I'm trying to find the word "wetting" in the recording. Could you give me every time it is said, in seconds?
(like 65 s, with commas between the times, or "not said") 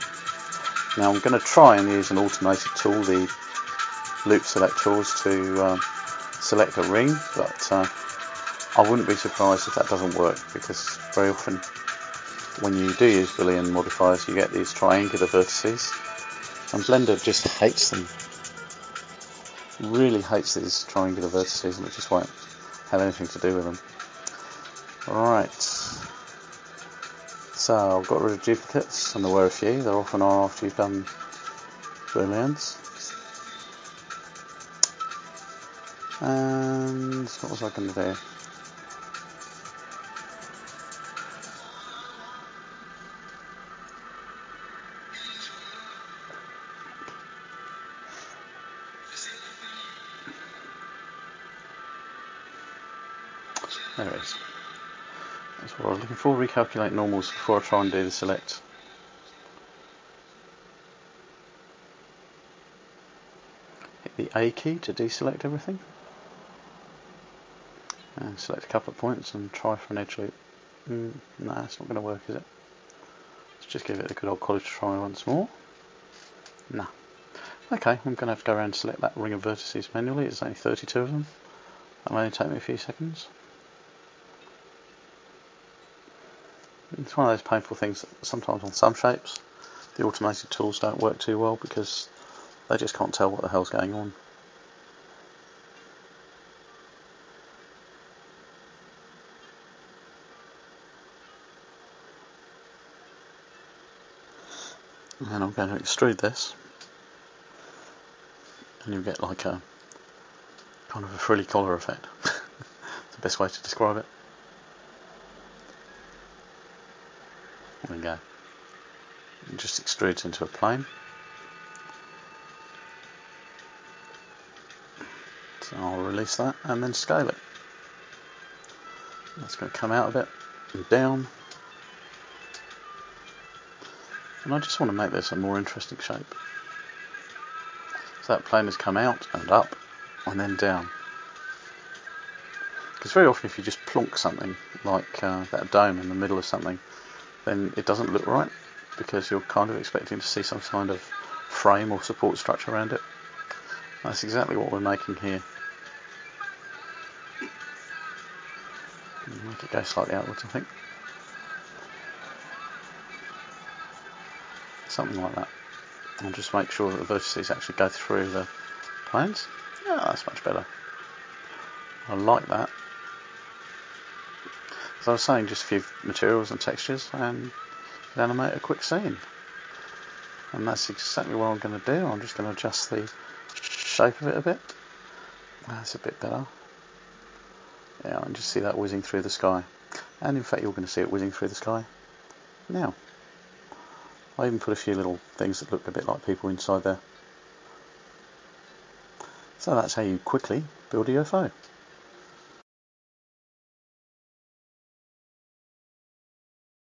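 not said.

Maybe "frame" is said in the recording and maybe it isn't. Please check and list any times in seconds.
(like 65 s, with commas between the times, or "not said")
151 s.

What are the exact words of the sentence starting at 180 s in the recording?
And that's exactly what I'm going to do.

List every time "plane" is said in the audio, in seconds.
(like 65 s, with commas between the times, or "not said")
120 s, 138 s, 169 s.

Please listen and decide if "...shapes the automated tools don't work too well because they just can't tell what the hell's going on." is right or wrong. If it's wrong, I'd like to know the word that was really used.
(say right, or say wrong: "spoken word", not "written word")
right.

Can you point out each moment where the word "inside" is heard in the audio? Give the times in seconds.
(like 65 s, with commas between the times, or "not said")
196 s.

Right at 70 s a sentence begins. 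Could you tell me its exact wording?
Mm, nah, it's not going to work, is it?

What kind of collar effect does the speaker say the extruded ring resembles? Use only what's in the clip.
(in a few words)
frilly.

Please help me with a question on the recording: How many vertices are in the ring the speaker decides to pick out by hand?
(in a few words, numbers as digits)
32.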